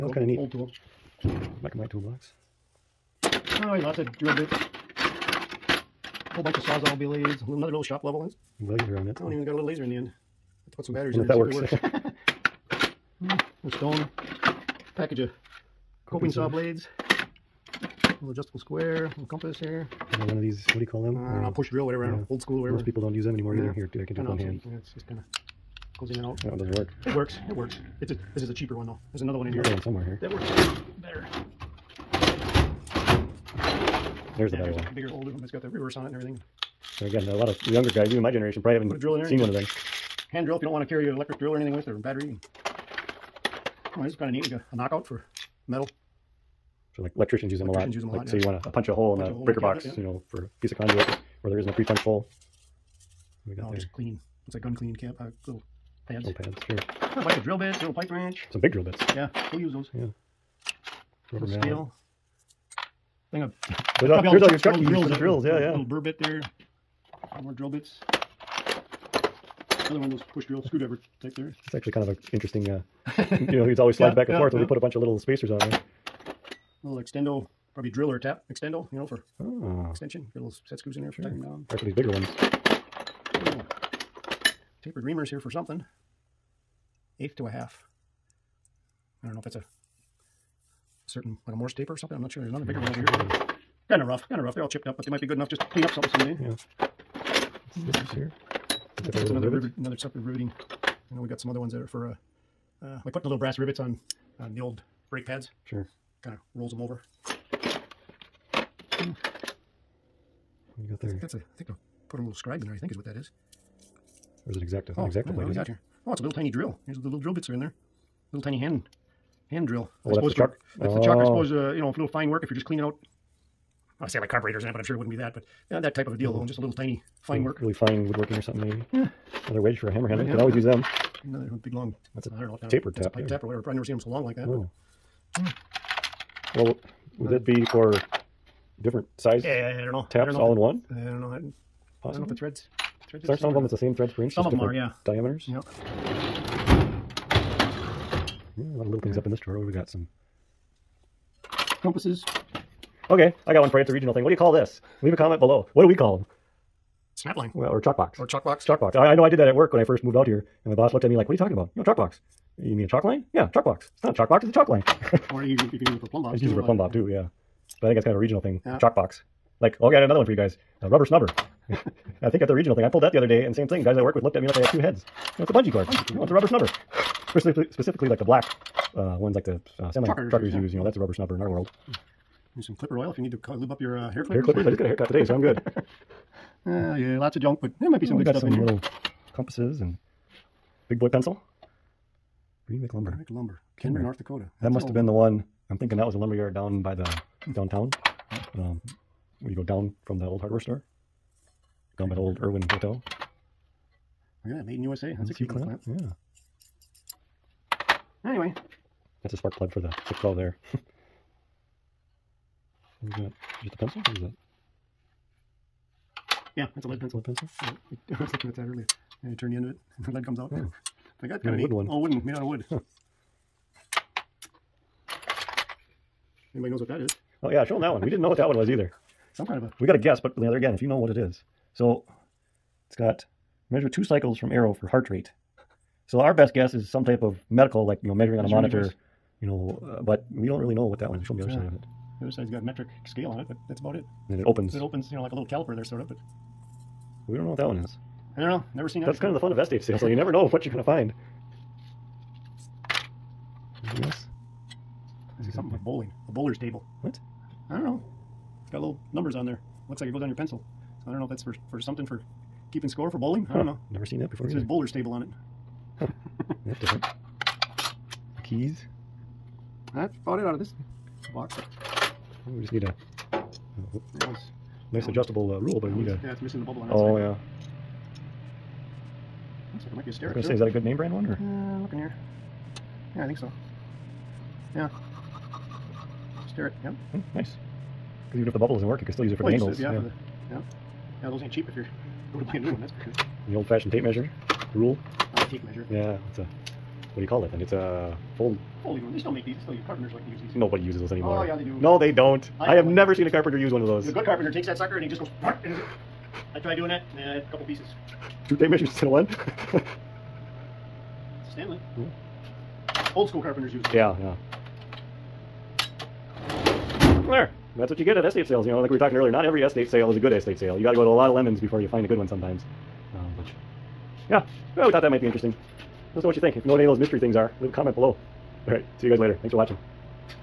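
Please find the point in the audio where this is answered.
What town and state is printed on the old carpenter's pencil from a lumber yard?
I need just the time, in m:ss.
3:13.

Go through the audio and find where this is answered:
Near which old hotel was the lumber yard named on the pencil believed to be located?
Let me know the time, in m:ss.
3:22.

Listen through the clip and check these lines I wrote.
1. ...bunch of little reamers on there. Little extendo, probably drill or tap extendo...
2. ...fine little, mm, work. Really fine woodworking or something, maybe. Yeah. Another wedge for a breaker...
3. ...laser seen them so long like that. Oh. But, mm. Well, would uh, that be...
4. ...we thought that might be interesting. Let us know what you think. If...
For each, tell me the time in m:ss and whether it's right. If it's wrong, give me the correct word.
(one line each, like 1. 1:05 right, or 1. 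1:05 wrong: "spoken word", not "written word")
1. 1:14 wrong: "spacers", not "reamers"
2. 2:07 wrong: "hammer", not "breaker"
3. 2:13 wrong: "never", not "laser"
4. 5:24 right.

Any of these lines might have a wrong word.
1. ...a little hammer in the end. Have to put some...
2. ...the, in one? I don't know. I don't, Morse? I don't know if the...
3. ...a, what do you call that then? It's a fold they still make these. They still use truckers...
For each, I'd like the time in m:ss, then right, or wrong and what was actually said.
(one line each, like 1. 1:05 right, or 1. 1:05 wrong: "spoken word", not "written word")
1. 0:09 wrong: "laser", not "hammer"
2. 2:20 wrong: "Possibly", not "Morse"
3. 4:56 wrong: "carpenters", not "truckers".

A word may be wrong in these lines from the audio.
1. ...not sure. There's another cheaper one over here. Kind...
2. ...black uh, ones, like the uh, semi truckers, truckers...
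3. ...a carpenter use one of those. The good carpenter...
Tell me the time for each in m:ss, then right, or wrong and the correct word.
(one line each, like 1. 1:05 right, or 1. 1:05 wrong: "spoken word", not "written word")
1. 1:32 wrong: "bigger", not "cheaper"
2. 2:58 right
3. 5:03 right.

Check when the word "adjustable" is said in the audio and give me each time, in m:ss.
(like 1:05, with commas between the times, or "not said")
0:18, 4:35.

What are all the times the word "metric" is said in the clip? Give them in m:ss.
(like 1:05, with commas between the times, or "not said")
4:02.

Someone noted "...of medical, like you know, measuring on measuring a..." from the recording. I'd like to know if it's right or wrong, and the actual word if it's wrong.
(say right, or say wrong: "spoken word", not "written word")
right.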